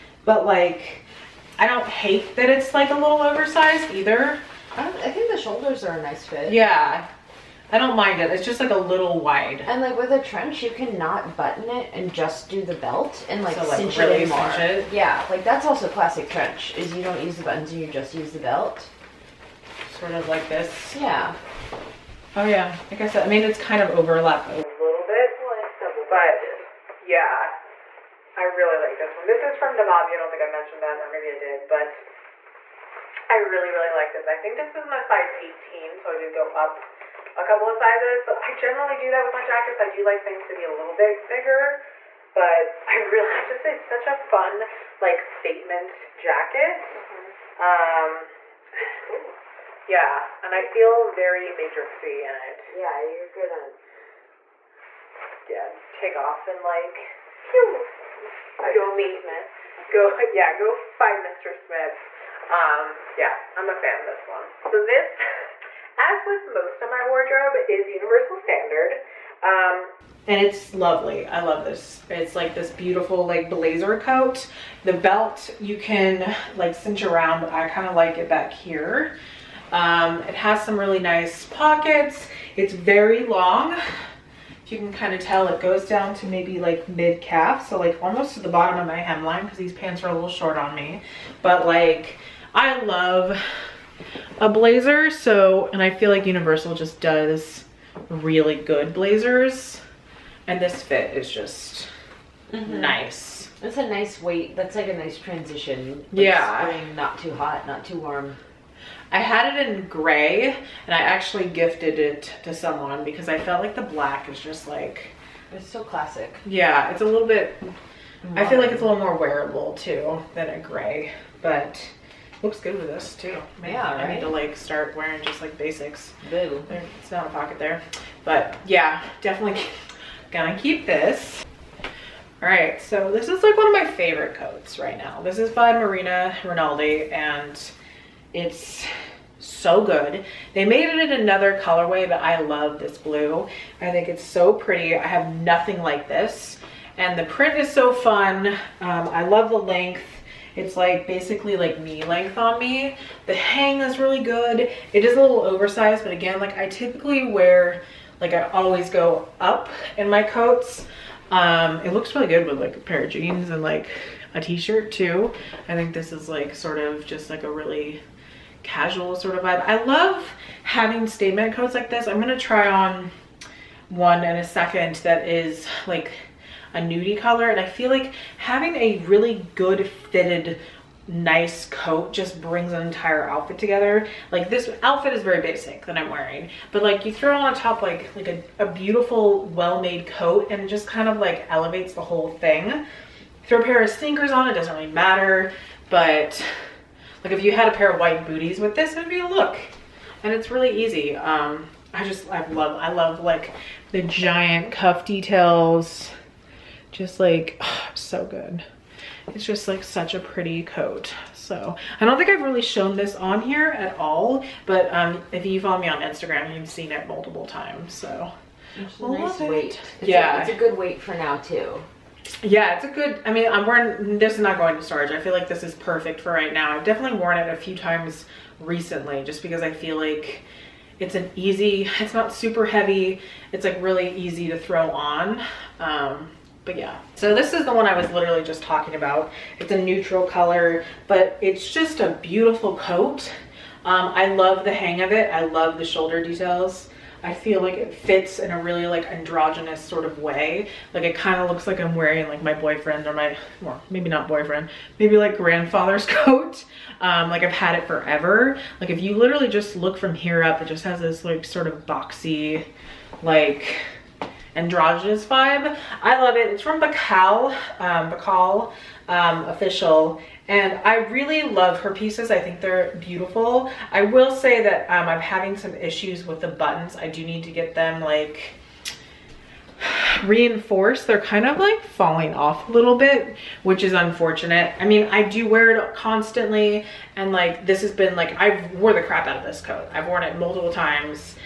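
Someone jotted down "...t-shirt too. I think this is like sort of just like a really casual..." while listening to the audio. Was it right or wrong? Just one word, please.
right.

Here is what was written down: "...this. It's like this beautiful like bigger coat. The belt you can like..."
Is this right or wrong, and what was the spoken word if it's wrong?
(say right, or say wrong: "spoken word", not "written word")
wrong: "blazer", not "bigger".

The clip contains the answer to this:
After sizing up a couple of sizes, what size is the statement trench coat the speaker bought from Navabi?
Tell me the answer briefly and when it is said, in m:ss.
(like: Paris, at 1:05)
18, at 0:35.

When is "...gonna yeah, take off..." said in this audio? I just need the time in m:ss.
0:53.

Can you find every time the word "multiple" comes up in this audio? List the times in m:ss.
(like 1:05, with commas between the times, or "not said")
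3:37, 4:50.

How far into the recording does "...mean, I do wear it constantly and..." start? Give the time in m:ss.
4:44.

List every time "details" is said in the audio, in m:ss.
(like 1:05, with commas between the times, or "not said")
3:25, 4:06.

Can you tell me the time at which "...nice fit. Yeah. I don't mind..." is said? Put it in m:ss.
0:06.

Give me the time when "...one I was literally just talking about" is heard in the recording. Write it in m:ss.
3:57.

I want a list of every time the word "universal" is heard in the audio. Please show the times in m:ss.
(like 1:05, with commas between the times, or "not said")
1:07, 1:36.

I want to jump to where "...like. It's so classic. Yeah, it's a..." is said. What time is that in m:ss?
1:54.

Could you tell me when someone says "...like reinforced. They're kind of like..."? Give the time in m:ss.
4:38.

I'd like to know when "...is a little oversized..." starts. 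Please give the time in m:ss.
2:35.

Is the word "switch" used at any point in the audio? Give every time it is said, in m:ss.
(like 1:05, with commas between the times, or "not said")
not said.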